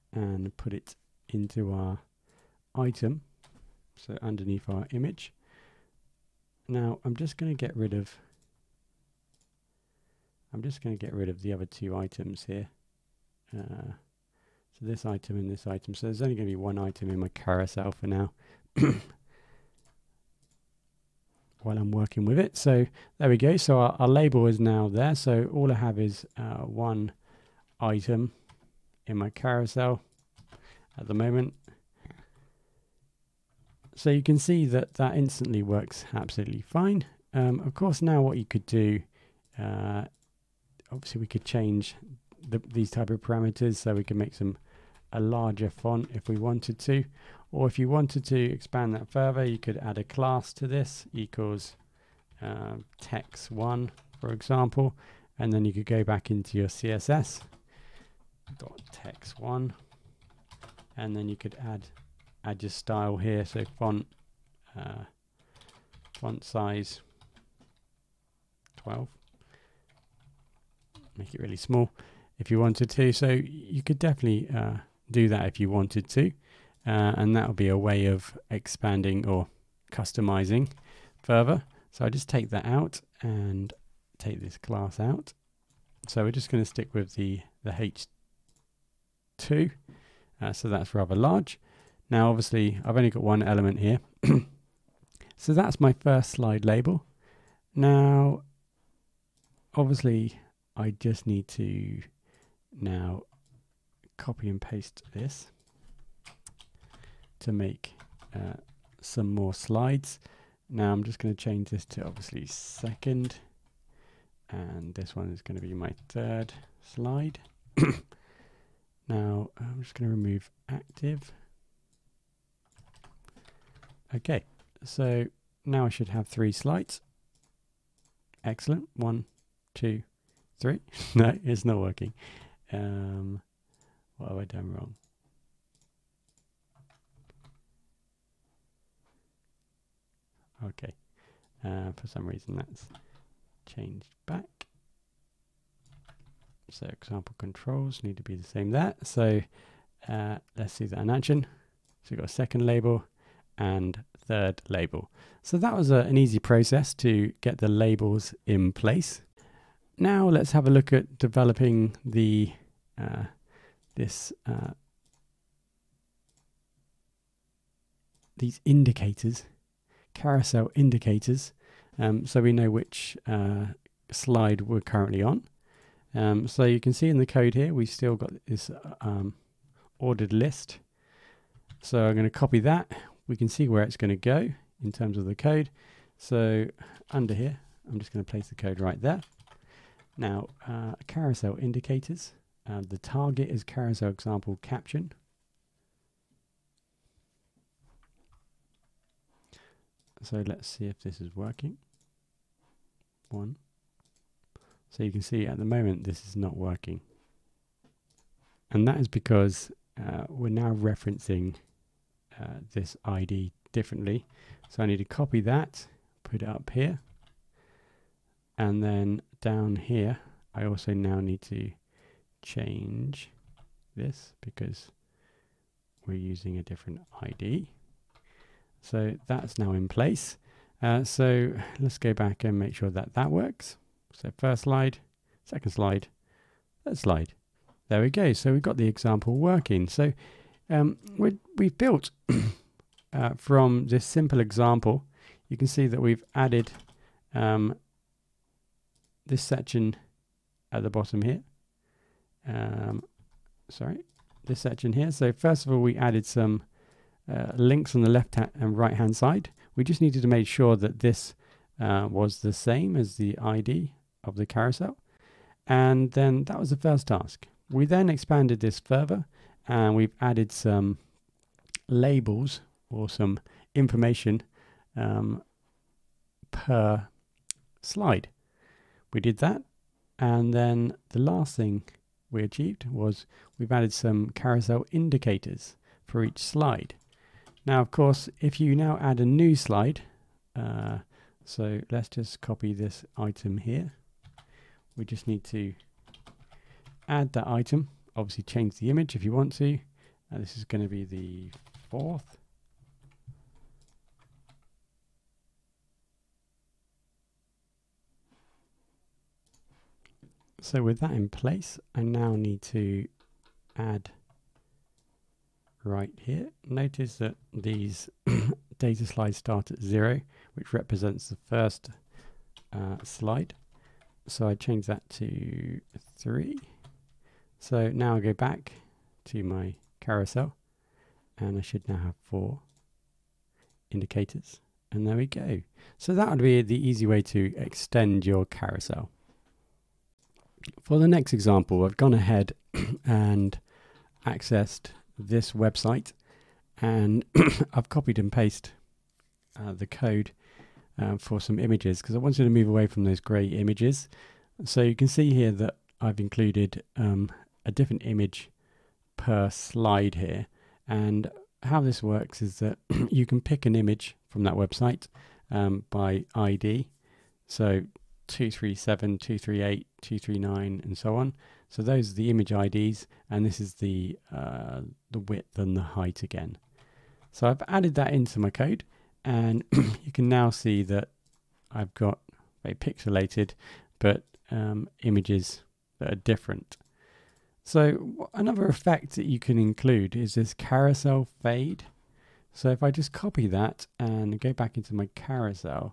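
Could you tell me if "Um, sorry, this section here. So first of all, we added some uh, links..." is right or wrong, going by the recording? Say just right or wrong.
right.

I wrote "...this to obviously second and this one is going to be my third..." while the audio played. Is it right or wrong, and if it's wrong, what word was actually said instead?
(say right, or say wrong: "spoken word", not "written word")
right.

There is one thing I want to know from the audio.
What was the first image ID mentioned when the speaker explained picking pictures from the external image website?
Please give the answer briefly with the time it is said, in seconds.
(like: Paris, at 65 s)
237, at 368 s.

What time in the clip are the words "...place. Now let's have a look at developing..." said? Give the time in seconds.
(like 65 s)
158 s.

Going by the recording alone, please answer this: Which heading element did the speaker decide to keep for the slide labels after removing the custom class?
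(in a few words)
H2.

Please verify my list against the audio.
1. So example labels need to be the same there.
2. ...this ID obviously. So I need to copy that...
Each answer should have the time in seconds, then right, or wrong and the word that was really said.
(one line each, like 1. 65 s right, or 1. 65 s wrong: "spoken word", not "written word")
1. 146 s wrong: "controls", not "labels"
2. 212 s wrong: "differently", not "obviously".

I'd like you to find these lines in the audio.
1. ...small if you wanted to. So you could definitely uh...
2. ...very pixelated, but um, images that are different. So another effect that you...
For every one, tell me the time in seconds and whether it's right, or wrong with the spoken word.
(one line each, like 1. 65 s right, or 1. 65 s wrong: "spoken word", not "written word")
1. 71 s right
2. 382 s right.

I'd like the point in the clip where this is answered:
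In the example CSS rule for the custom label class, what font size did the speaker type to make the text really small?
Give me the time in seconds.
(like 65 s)
66 s.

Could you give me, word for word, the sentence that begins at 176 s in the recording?
Um, so you can see in the code here, we still got this uh, um, ordered list.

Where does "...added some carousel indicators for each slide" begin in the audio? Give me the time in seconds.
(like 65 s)
283 s.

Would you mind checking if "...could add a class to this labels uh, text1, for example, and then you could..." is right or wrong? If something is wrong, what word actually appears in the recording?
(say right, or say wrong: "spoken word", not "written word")
wrong: "equals", not "labels".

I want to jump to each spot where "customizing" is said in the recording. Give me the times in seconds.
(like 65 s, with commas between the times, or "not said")
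79 s.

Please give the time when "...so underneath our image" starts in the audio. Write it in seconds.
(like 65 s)
3 s.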